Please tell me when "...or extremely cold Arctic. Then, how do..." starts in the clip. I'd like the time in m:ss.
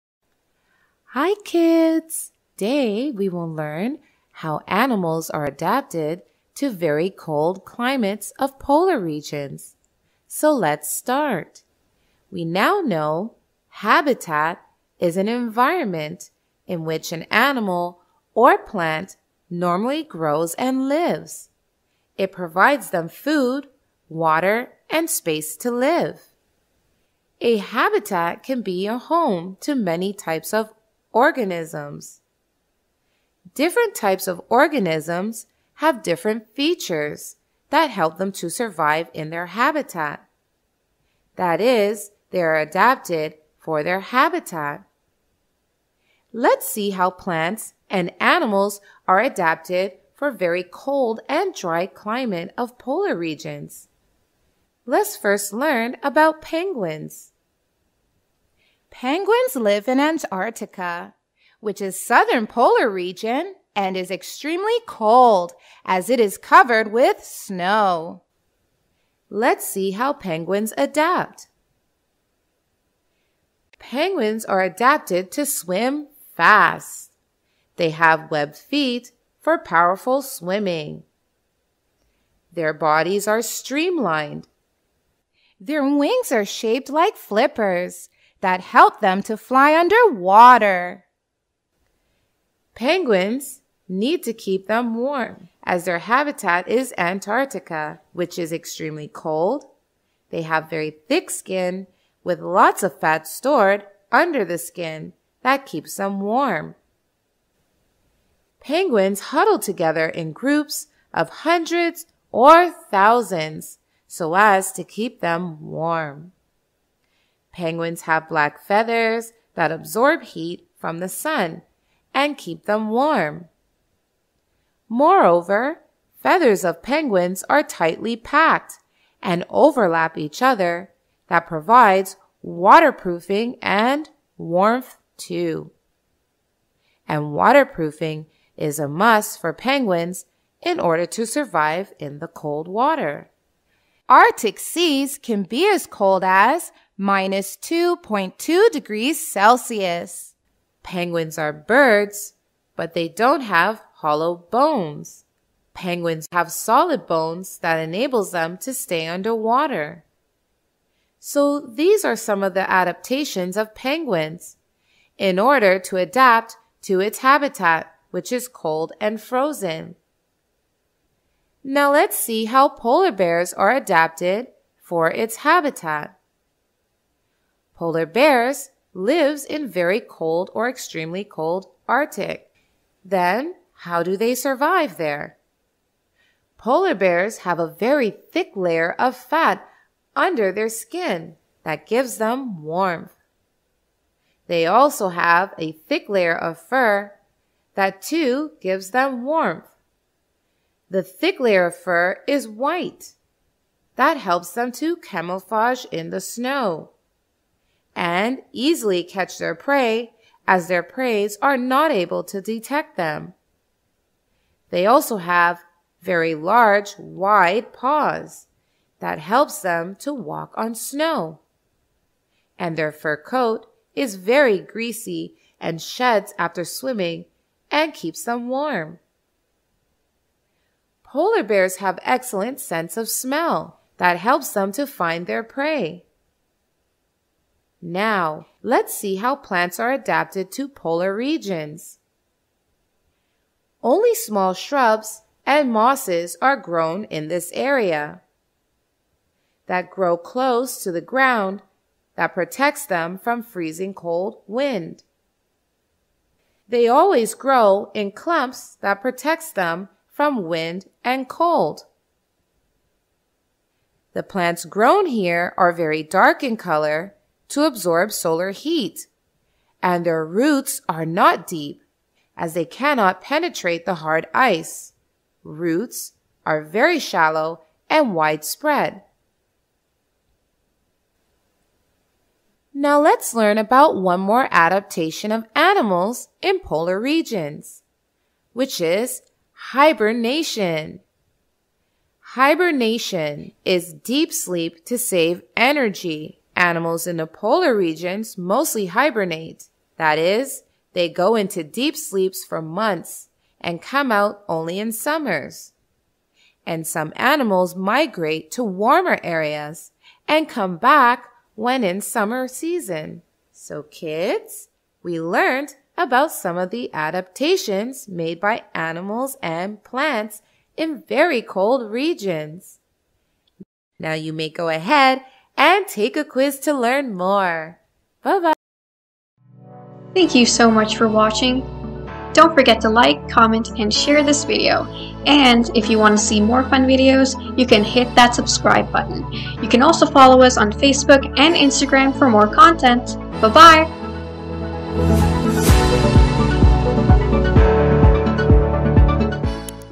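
3:00.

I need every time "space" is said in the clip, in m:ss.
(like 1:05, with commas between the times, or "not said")
0:25.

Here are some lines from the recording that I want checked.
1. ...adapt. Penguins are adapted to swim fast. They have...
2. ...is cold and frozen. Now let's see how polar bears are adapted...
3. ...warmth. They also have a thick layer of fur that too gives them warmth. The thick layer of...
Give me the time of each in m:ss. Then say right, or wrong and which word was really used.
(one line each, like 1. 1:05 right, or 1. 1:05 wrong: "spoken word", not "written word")
1. 1:10 right
2. 2:48 right
3. 3:12 right.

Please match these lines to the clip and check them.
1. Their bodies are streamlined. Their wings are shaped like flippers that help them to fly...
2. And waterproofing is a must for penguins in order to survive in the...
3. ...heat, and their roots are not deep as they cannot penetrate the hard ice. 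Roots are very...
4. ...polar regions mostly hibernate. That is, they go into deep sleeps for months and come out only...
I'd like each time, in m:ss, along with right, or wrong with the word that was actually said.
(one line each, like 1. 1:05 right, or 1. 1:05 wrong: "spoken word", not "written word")
1. 1:22 right
2. 2:17 right
3. 4:28 right
4. 4:57 right.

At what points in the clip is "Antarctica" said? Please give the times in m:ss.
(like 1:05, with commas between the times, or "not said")
0:59, 1:36.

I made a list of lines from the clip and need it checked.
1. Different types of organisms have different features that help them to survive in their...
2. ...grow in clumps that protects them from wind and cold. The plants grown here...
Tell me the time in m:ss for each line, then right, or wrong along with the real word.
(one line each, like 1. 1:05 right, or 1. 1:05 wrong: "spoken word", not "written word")
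1. 0:33 right
2. 4:17 right.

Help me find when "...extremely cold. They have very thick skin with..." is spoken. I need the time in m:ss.
1:38.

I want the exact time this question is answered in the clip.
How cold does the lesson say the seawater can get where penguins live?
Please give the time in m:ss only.
2:26.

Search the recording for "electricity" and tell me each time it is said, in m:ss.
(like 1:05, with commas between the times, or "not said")
not said.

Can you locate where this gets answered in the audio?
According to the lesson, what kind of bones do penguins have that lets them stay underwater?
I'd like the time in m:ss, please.
2:36.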